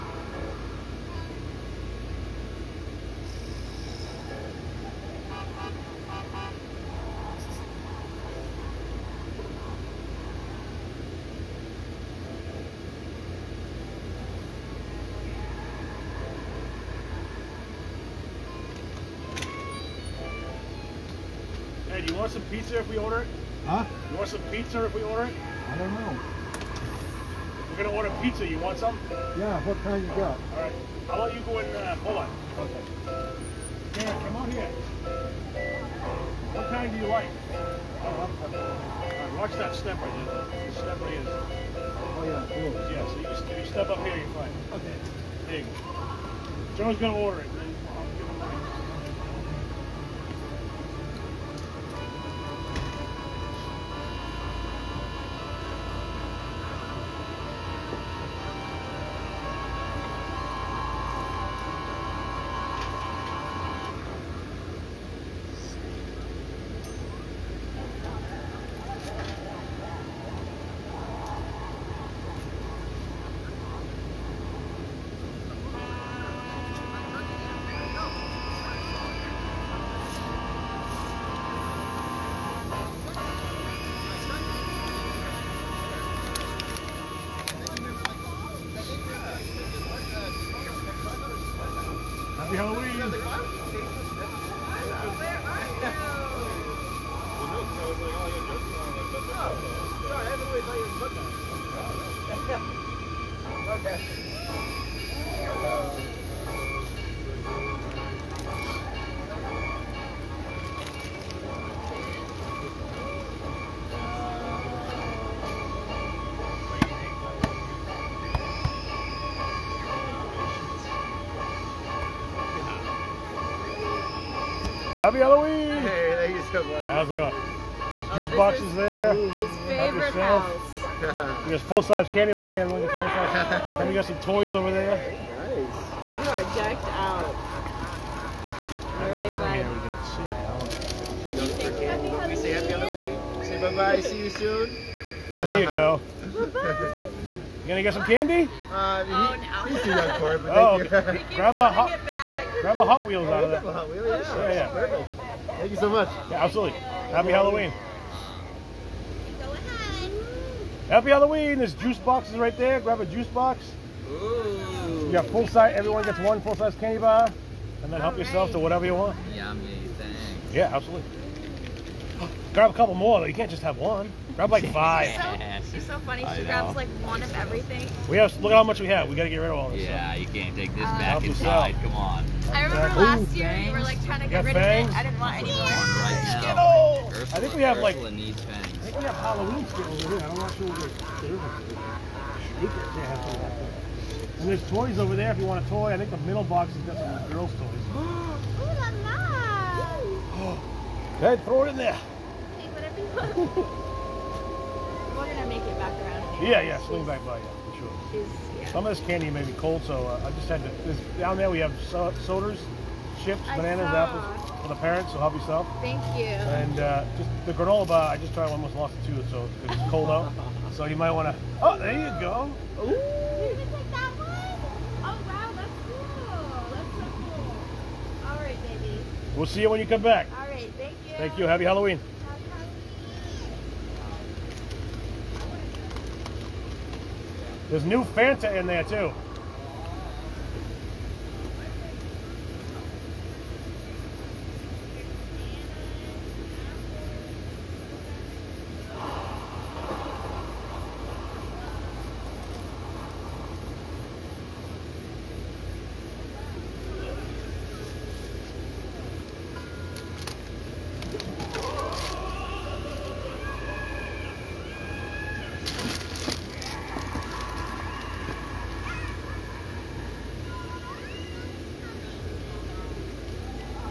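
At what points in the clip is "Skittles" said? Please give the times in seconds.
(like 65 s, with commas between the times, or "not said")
189 s.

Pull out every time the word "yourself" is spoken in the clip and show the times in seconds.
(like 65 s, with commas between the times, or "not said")
168 s, 215 s.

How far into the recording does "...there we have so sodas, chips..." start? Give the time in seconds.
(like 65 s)
211 s.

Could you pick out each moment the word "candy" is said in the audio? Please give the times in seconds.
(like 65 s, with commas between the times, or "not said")
132 s, 148 s, 166 s, 209 s.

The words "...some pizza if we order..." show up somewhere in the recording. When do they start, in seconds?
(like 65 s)
24 s.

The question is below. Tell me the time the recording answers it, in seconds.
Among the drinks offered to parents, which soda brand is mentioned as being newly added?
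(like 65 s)
238 s.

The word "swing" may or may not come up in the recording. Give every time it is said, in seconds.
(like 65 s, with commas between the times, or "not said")
206 s.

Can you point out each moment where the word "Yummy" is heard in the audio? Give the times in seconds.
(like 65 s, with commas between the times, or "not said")
169 s.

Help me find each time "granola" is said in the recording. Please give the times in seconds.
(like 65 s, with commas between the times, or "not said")
217 s.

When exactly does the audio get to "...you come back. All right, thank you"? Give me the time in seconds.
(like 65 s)
229 s.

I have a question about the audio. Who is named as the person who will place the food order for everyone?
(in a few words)
Joe.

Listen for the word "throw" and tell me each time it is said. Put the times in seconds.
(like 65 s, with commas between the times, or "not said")
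201 s.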